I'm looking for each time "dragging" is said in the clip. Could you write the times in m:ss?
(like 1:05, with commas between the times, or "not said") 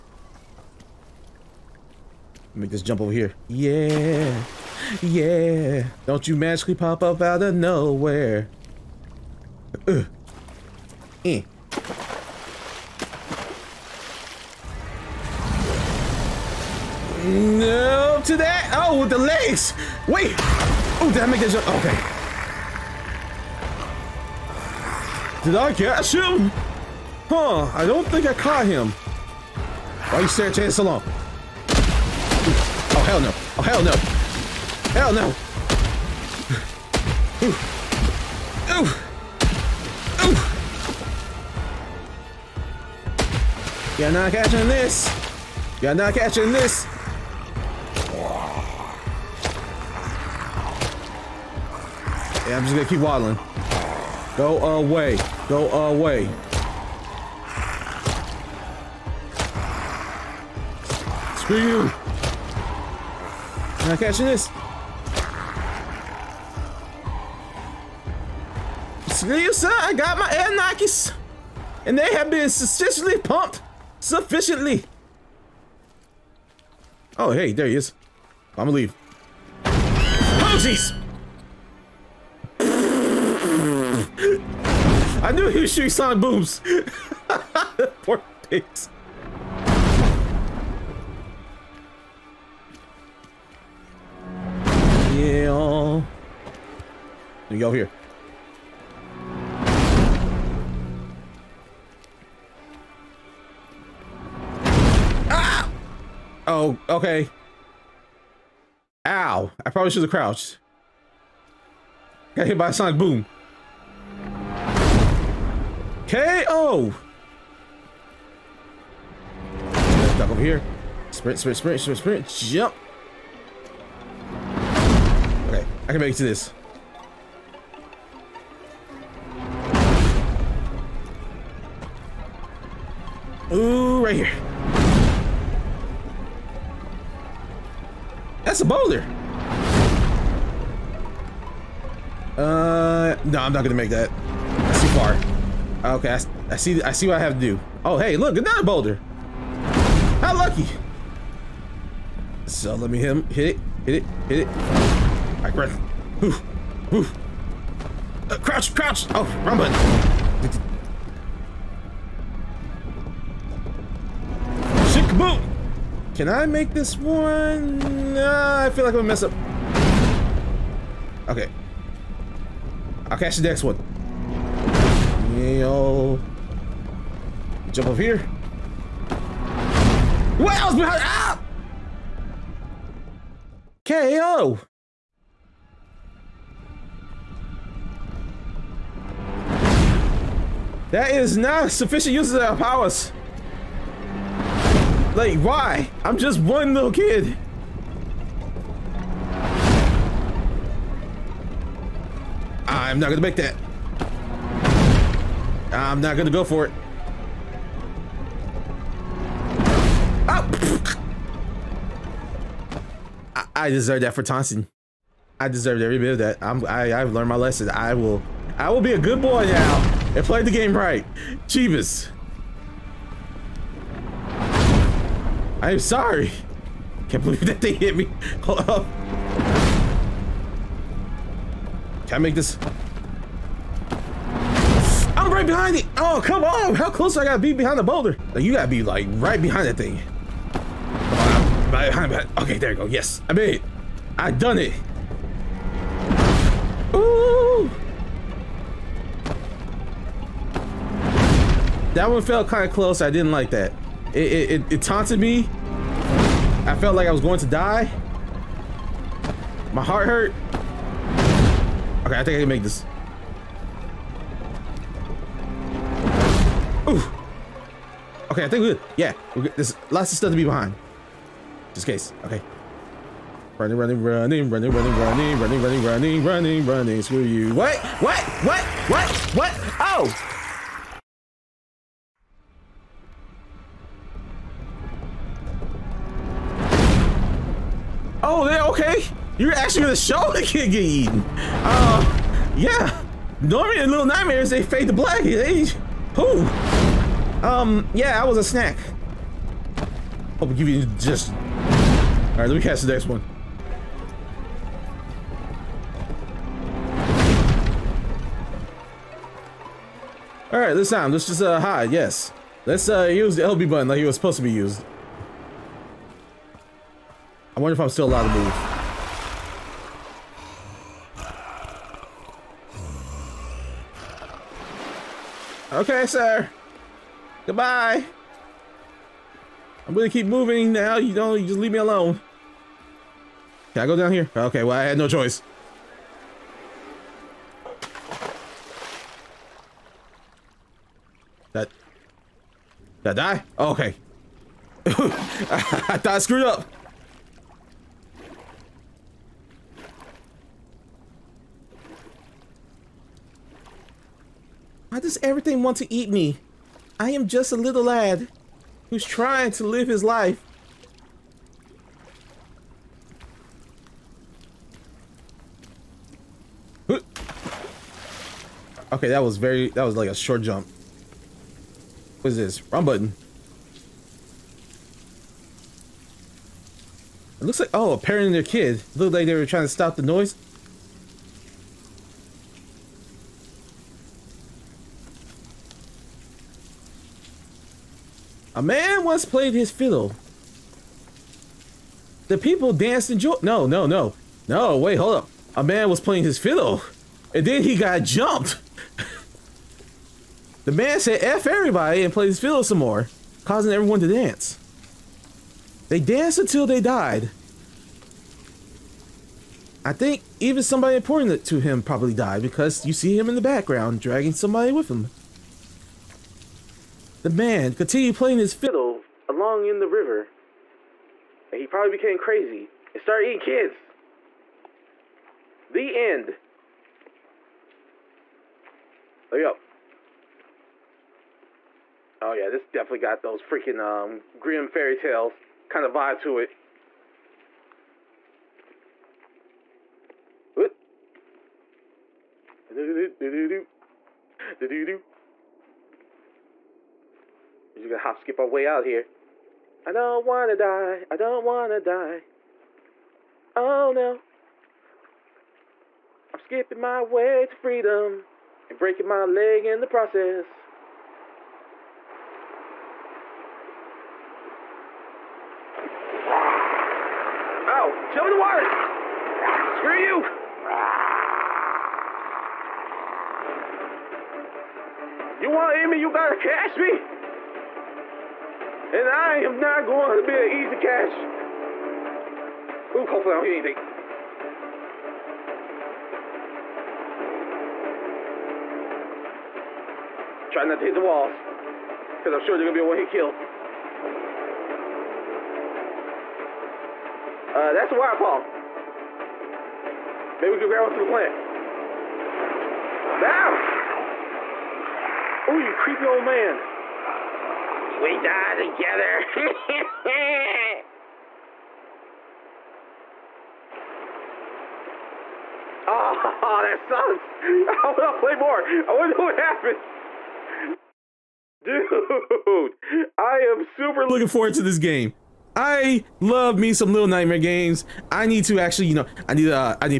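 6:54.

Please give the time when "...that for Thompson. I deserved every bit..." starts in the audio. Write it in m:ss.
3:34.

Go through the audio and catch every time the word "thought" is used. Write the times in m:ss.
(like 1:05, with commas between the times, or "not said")
5:45.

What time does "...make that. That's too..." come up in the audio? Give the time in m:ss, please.
2:23.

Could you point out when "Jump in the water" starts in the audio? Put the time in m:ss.
7:48.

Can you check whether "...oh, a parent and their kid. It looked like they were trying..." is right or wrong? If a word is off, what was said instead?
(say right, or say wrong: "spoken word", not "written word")
right.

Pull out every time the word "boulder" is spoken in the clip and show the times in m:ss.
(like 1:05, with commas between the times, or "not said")
2:18, 2:28, 3:57.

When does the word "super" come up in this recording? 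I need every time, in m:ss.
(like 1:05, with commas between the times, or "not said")
8:43.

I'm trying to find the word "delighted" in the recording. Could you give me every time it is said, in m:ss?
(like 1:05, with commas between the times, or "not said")
not said.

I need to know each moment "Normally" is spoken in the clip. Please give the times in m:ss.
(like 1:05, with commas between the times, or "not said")
4:53.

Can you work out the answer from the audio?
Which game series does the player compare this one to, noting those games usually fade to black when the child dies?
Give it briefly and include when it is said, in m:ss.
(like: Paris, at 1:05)
Little Nightmares, at 4:53.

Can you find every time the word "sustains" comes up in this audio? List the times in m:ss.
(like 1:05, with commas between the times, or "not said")
not said.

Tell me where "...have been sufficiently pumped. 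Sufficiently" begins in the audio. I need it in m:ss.
1:12.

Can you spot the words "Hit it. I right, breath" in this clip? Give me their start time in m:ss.
2:34.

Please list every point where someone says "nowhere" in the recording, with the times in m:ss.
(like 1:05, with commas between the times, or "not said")
0:07.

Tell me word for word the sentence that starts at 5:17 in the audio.
I wonder if I'm still allowed to move.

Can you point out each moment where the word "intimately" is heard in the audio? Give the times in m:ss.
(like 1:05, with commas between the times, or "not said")
not said.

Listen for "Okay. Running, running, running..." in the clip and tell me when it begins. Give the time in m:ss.
4:32.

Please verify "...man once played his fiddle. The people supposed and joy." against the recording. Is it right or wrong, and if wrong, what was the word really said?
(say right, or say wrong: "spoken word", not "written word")
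wrong: "danced", not "supposed".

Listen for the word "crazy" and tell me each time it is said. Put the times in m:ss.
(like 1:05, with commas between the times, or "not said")
7:02.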